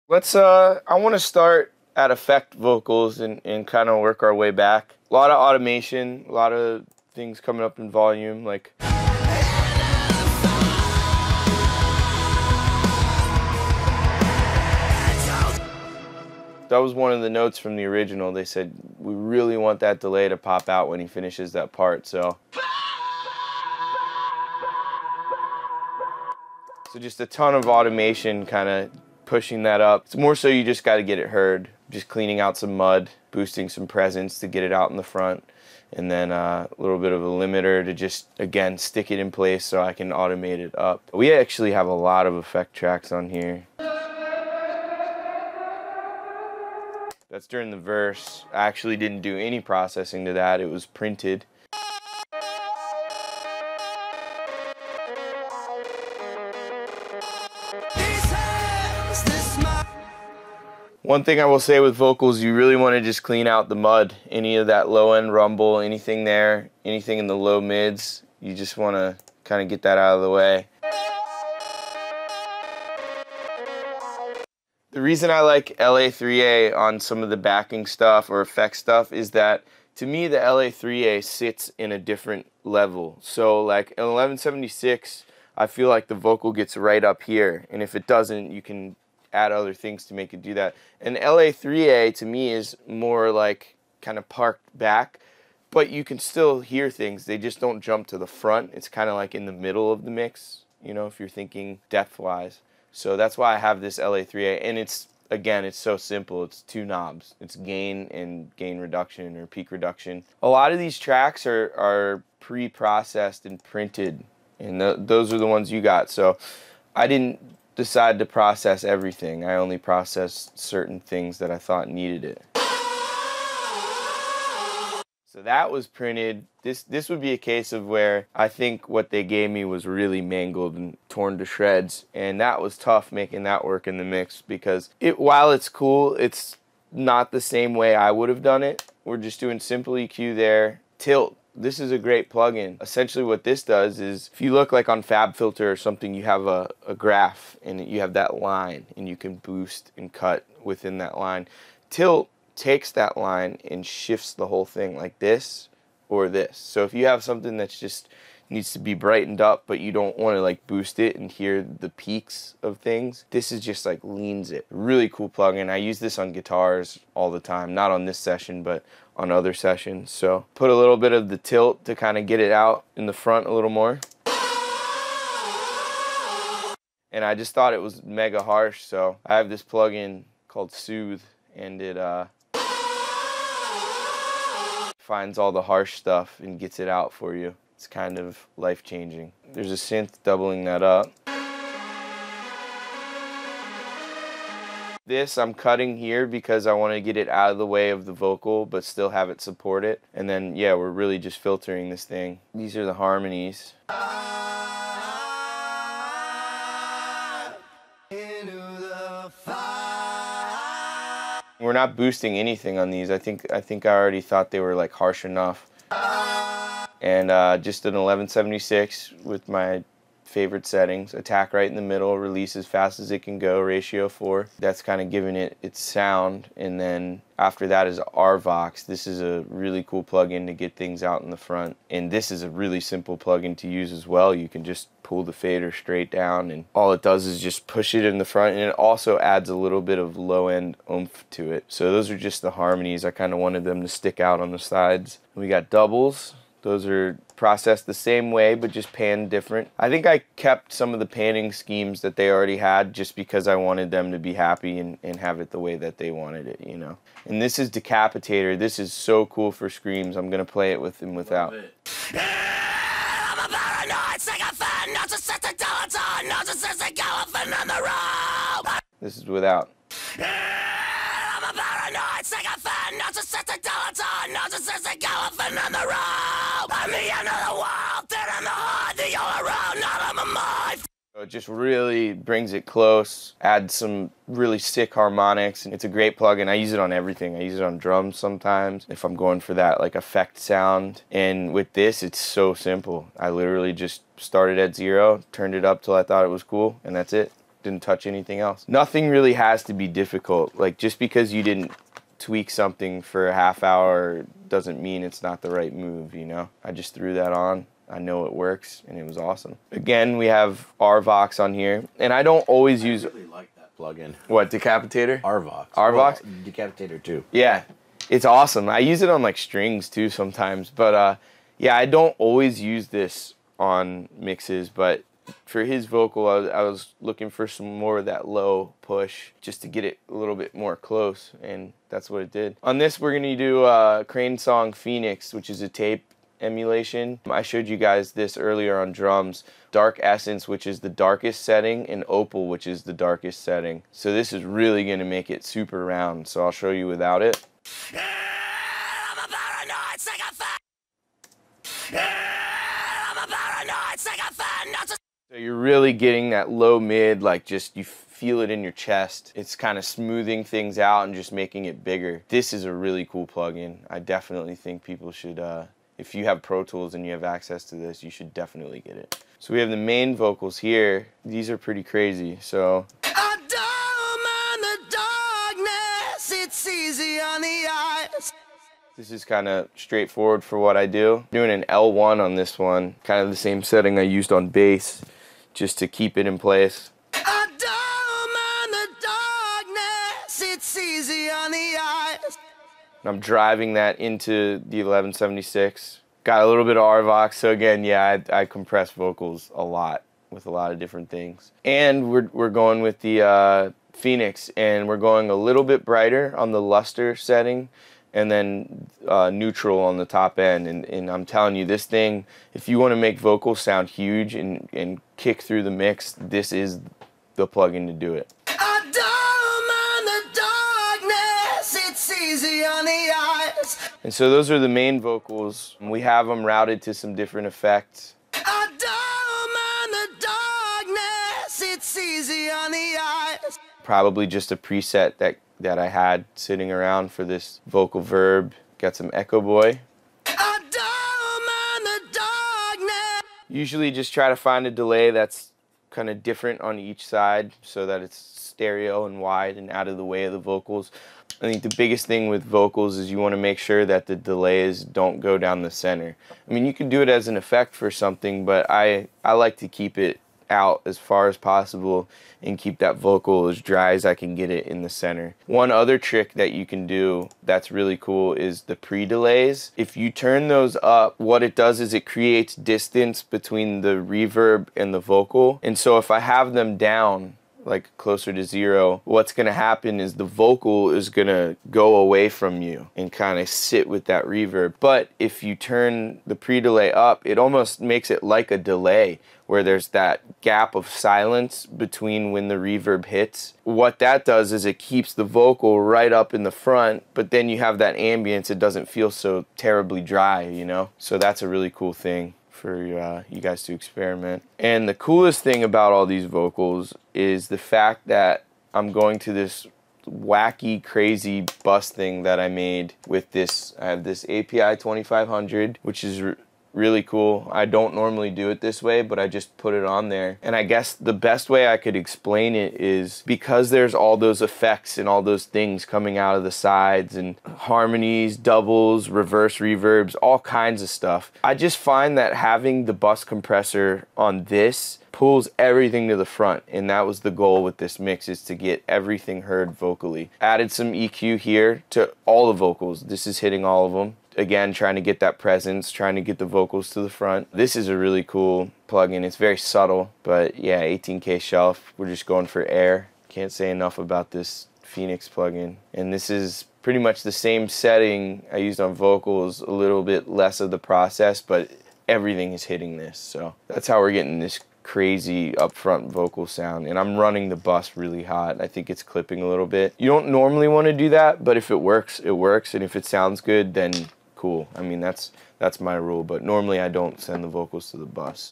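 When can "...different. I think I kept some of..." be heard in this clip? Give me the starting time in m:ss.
4:09.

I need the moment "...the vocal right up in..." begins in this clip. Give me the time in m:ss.
8:15.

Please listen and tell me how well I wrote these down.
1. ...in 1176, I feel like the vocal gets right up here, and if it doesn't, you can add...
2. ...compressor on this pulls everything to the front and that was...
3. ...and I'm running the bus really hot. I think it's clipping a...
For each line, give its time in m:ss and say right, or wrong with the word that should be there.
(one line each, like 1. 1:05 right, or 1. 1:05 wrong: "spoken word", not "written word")
1. 1:23 right
2. 8:53 right
3. 9:26 right.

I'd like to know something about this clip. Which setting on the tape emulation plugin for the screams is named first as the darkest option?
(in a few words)
Dark Essence.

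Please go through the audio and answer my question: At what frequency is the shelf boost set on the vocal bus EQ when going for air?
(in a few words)
18k.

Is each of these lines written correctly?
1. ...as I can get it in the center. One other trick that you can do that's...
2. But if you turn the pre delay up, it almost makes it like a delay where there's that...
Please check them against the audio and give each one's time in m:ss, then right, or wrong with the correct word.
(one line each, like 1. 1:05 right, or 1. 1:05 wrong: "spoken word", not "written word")
1. 7:43 right
2. 8:04 right.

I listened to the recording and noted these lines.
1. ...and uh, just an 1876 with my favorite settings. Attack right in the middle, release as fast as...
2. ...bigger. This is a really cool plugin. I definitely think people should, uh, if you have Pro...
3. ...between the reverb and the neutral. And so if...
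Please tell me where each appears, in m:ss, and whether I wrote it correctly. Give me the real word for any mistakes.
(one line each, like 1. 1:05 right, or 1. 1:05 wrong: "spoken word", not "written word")
1. 3:37 wrong: "1176", not "1876"
2. 6:01 right
3. 7:53 wrong: "vocal", not "neutral".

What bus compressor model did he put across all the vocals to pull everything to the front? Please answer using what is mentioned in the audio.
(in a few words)
API 2500.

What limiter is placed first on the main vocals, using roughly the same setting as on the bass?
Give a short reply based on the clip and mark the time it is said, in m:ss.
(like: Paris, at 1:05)
L1, at 6:21.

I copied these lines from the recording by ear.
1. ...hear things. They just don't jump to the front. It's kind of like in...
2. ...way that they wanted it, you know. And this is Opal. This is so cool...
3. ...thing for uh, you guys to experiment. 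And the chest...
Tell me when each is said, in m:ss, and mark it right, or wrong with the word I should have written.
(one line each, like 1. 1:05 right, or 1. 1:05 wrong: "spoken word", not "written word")
1. 1:36 right
2. 4:15 wrong: "Decapitator", not "Opal"
3. 8:21 wrong: "coolest", not "chest".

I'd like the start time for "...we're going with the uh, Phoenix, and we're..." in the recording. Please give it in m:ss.
6:42.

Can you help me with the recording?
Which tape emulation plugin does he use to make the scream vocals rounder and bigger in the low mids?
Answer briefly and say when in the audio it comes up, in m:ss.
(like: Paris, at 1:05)
Crane Song Phoenix, at 5:34.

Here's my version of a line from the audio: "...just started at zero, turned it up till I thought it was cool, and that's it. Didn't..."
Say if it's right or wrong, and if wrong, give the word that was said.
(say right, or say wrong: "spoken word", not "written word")
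right.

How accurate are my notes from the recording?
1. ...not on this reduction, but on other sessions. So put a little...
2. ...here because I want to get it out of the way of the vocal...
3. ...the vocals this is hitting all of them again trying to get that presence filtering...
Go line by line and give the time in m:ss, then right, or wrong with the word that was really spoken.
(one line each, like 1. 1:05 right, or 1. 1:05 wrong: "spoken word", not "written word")
1. 2:47 wrong: "session", not "reduction"
2. 3:15 right
3. 9:02 wrong: "trying", not "filtering".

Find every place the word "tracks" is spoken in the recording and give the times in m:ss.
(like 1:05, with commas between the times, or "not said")
0:42, 1:50.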